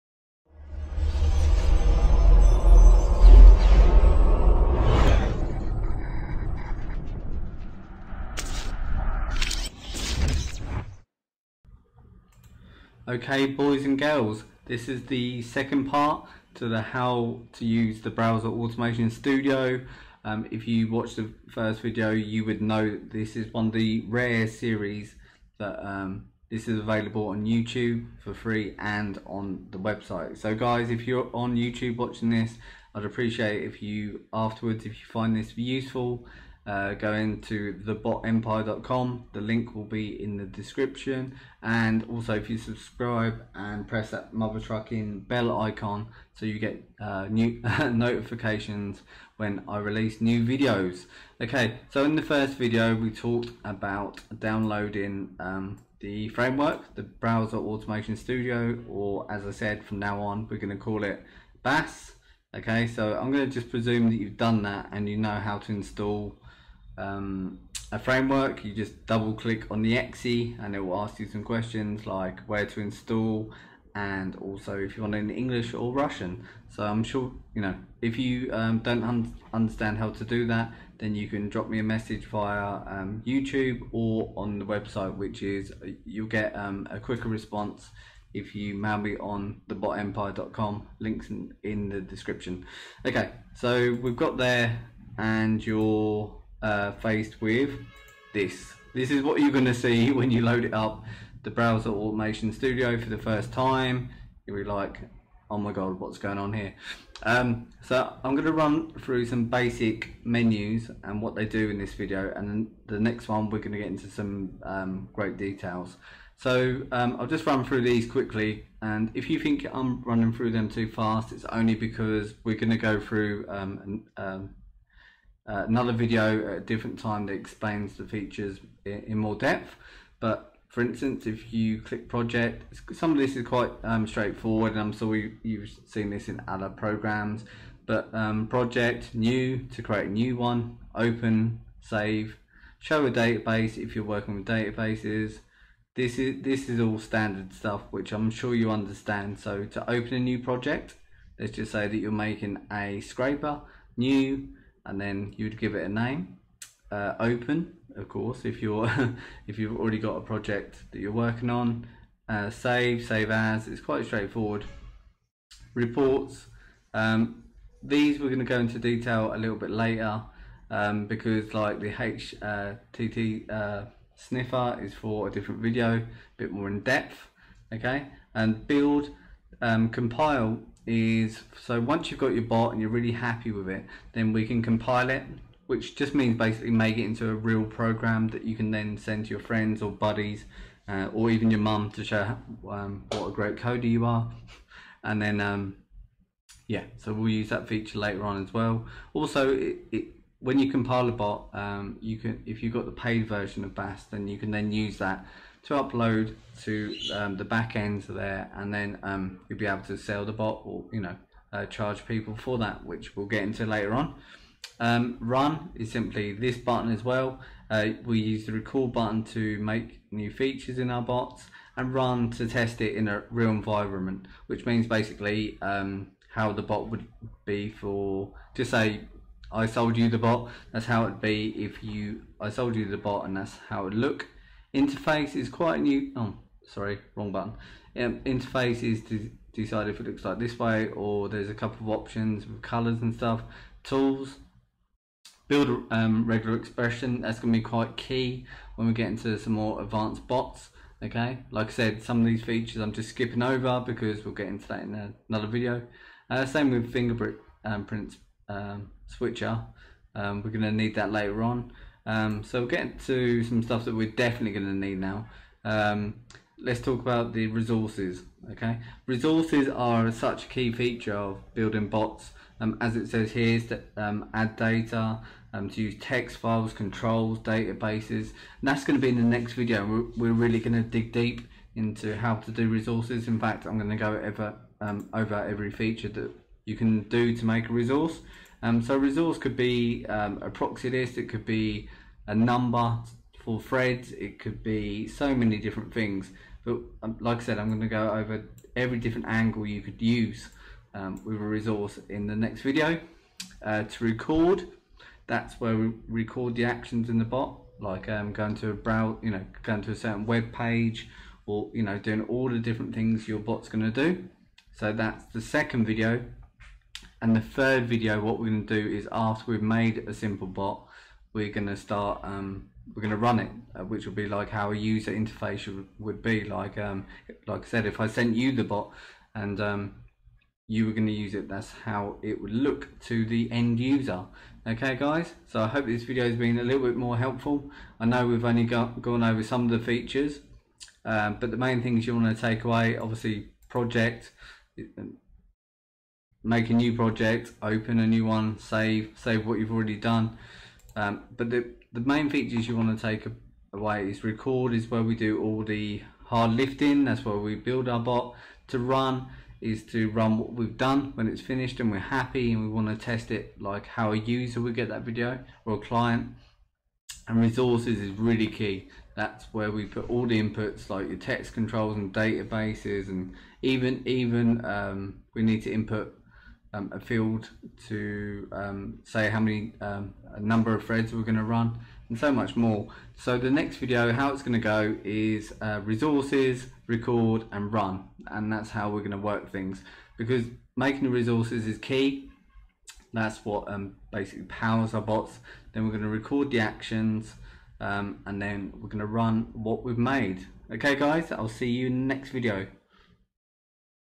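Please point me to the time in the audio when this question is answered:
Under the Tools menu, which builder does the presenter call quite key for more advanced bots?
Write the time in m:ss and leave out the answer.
4:06.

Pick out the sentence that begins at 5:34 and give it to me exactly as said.
Okay guys, so I hope this video has been a little bit more helpful.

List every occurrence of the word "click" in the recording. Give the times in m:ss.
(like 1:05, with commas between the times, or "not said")
1:09, 2:11.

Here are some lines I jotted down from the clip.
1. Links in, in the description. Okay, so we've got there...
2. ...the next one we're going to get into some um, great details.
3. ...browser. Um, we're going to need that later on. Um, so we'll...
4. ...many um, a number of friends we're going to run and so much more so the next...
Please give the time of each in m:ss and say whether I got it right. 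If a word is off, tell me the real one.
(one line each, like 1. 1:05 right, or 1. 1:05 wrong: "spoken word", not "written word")
1. 1:30 right
2. 1:52 right
3. 4:19 wrong: "switcher", not "browser"
4. 6:19 wrong: "threads", not "friends".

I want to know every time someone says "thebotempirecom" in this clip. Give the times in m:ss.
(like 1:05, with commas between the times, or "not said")
0:37, 1:29.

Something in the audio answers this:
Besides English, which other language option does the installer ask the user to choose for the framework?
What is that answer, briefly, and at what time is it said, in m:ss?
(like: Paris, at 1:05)
Russian, at 1:15.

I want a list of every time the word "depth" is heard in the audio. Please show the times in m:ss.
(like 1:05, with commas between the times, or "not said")
2:09, 2:56.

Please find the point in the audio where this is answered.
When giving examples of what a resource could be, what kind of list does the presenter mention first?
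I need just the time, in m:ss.
4:50.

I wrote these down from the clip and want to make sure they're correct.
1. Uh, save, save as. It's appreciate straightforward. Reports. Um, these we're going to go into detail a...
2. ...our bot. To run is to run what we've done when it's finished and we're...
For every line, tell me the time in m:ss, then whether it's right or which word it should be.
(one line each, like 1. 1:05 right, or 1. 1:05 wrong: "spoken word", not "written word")
1. 2:42 wrong: "quite", not "appreciate"
2. 5:57 right.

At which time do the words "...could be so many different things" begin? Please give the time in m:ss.
4:54.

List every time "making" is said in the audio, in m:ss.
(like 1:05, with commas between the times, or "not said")
2:32, 6:30.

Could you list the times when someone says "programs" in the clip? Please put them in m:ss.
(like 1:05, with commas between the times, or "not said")
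2:16, 3:07.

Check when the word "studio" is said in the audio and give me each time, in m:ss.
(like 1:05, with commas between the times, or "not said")
0:19, 0:58, 1:42.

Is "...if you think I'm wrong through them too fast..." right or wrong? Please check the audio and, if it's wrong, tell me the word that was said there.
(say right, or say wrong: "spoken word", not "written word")
wrong: "running", not "wrong".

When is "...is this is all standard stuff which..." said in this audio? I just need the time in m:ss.
2:26.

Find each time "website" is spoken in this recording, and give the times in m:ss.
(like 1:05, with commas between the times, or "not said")
0:29, 1:24.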